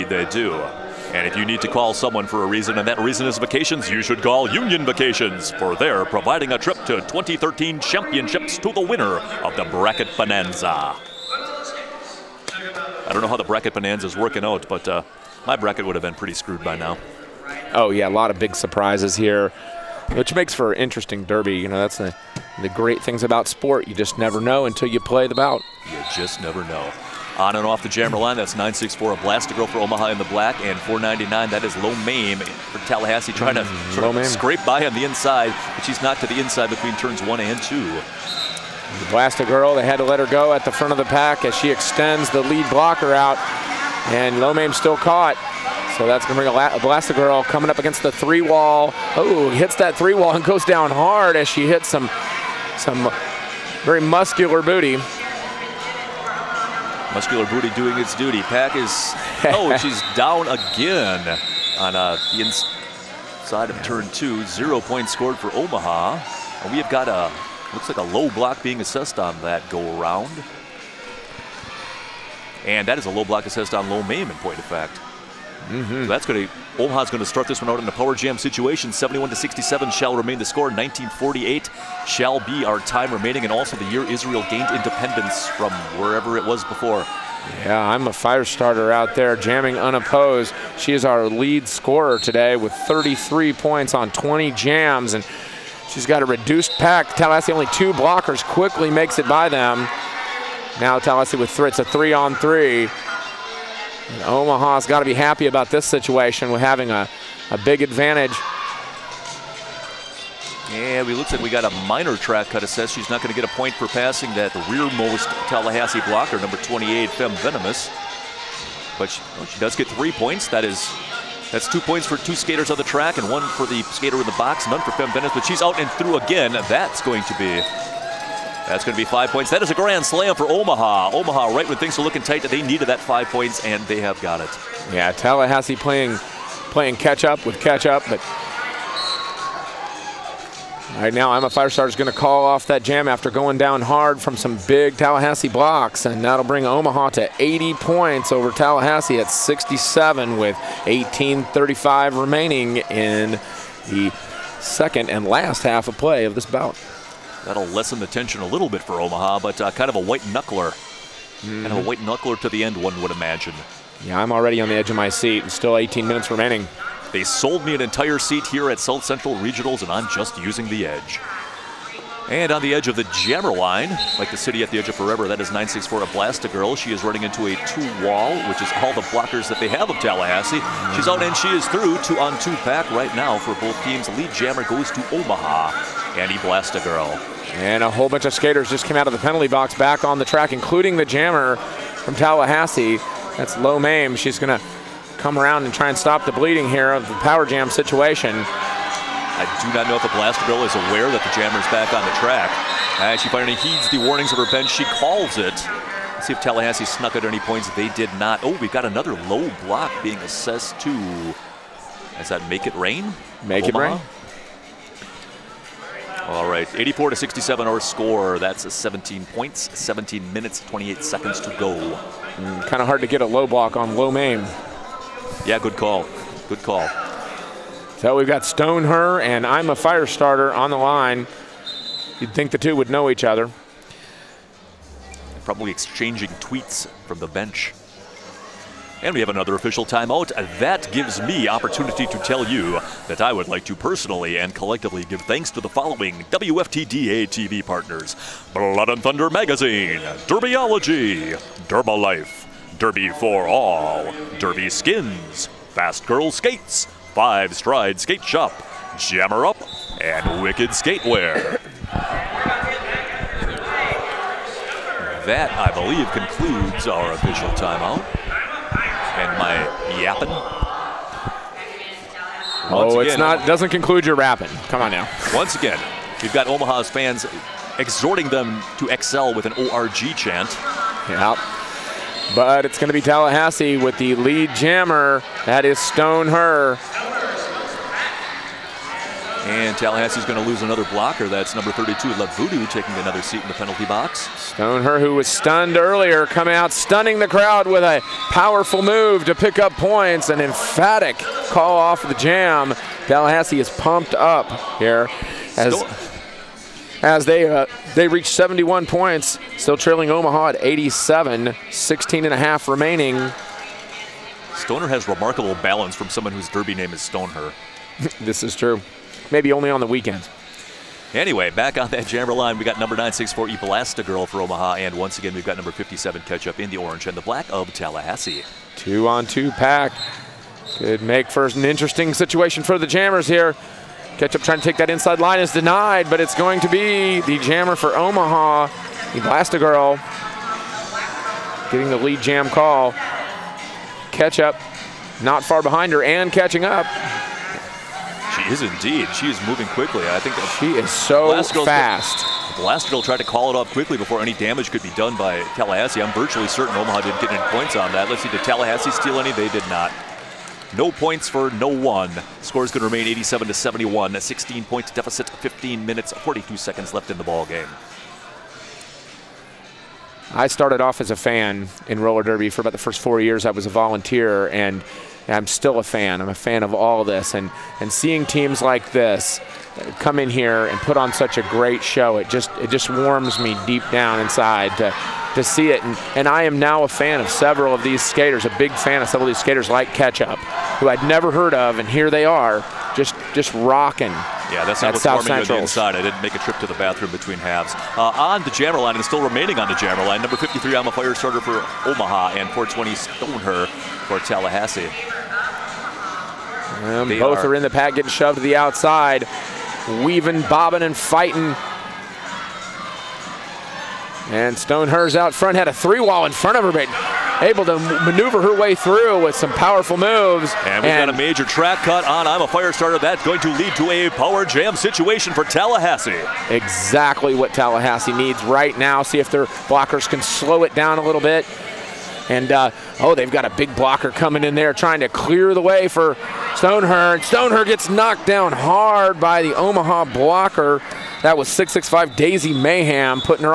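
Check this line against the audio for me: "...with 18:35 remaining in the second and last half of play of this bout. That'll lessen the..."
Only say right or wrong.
right.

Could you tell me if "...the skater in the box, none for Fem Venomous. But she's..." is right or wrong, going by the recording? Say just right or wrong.
right.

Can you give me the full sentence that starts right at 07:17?
And Stoneher gets knocked down hard by the Omaha blocker.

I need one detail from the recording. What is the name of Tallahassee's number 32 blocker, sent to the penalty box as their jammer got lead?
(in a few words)
Lavudu.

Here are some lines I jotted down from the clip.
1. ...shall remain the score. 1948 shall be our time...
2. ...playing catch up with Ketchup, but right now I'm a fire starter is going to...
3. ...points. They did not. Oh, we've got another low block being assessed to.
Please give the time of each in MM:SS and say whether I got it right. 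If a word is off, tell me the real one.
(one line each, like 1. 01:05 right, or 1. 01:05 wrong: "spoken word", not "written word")
1. 01:19 right
2. 02:16 right
3. 03:27 right.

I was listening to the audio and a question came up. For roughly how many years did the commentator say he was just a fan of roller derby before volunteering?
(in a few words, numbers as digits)
4.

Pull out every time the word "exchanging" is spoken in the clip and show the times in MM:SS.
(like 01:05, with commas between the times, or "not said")
03:55.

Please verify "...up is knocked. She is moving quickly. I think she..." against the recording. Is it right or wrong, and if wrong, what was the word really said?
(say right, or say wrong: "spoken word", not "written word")
wrong: "indeed", not "knocked".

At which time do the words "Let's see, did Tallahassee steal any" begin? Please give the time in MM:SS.
05:58.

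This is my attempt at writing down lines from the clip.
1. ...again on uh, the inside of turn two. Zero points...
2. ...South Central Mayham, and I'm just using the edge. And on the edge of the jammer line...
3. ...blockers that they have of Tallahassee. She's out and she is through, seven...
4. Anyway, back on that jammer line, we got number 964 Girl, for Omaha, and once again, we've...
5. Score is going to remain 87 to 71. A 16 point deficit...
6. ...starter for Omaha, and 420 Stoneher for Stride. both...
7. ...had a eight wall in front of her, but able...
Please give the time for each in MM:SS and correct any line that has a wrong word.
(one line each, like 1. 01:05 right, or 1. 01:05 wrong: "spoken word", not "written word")
1. 01:00 right
2. 02:48 wrong: "Regionals", not "Mayham"
3. 02:59 wrong: "two", not "seven"
4. 05:21 right
5. 06:02 right
6. 06:41 wrong: "Tallahassee", not "Stride"
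7. 06:55 wrong: "three", not "eight".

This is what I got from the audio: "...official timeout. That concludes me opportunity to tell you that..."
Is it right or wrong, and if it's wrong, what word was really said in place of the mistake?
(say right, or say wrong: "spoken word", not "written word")
wrong: "gives", not "concludes".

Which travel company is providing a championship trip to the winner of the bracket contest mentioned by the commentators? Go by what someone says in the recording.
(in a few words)
Union Vacations.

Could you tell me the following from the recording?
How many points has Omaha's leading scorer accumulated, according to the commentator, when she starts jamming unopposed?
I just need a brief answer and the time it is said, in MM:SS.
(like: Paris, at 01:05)
33, at 01:32.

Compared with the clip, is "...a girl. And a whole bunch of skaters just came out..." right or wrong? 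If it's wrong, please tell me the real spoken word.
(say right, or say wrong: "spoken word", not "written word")
right.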